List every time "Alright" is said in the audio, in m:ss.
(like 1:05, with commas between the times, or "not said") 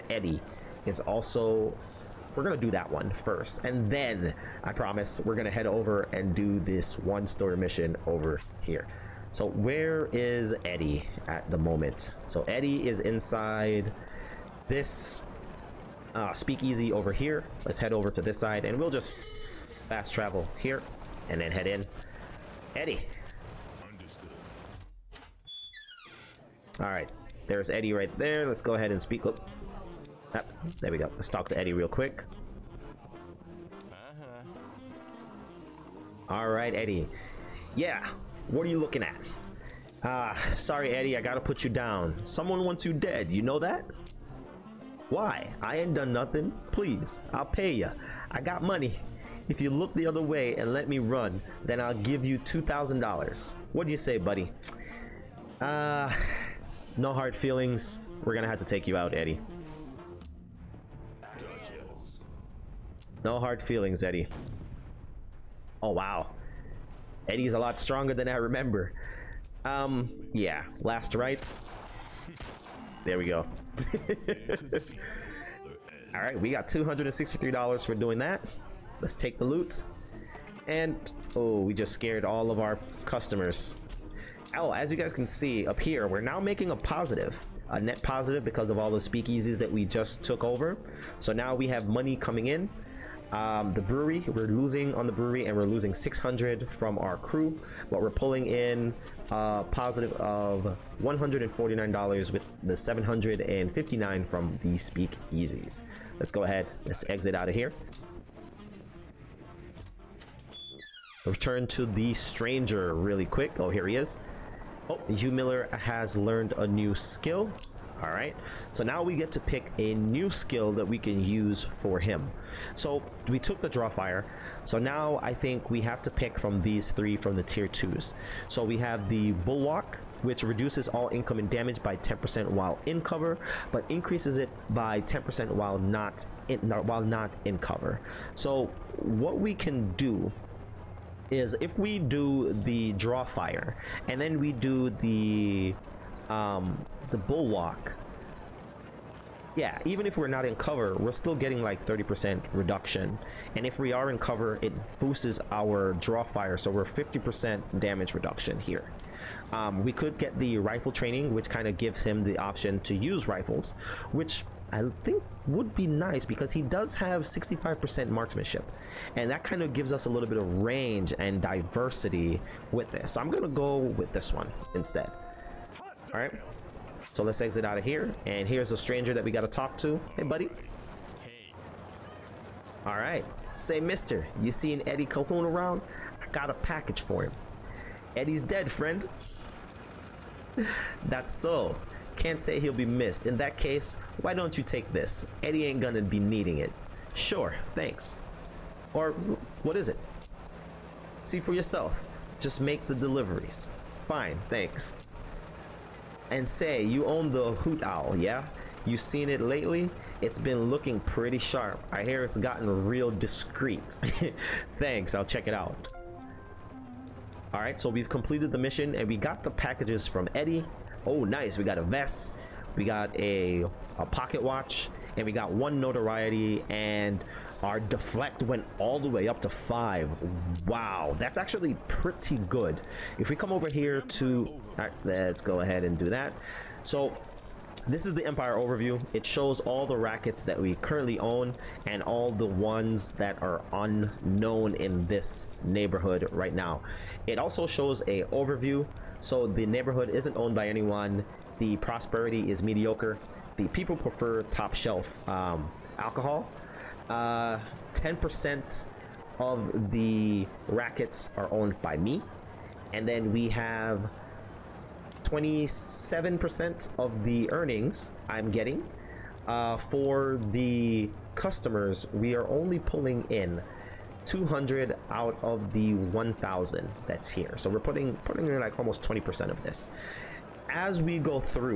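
3:37, 3:54.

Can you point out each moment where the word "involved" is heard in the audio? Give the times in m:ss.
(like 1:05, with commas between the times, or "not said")
not said.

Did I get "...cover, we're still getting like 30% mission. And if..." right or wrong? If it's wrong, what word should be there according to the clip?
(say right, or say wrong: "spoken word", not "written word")
wrong: "reduction", not "mission".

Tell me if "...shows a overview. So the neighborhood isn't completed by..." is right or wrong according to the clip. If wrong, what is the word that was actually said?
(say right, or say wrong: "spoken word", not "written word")
wrong: "owned", not "completed".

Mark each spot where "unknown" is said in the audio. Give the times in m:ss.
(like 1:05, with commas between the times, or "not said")
4:03.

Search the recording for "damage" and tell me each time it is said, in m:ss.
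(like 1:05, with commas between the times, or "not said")
2:11, 2:37.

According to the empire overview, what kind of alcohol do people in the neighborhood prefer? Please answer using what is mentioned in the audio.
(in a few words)
Top shelf.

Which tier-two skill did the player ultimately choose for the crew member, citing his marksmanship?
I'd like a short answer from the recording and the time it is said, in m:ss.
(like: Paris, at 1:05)
Rifle training, at 2:40.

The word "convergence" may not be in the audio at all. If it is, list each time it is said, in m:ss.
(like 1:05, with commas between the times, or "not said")
not said.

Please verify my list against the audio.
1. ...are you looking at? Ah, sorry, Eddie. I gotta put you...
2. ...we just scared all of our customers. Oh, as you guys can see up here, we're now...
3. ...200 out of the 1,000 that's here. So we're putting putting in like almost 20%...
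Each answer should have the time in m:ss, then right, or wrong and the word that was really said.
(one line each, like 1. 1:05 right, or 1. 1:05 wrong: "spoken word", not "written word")
1. 0:38 right
2. 1:21 right
3. 4:34 right.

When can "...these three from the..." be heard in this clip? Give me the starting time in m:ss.
2:06.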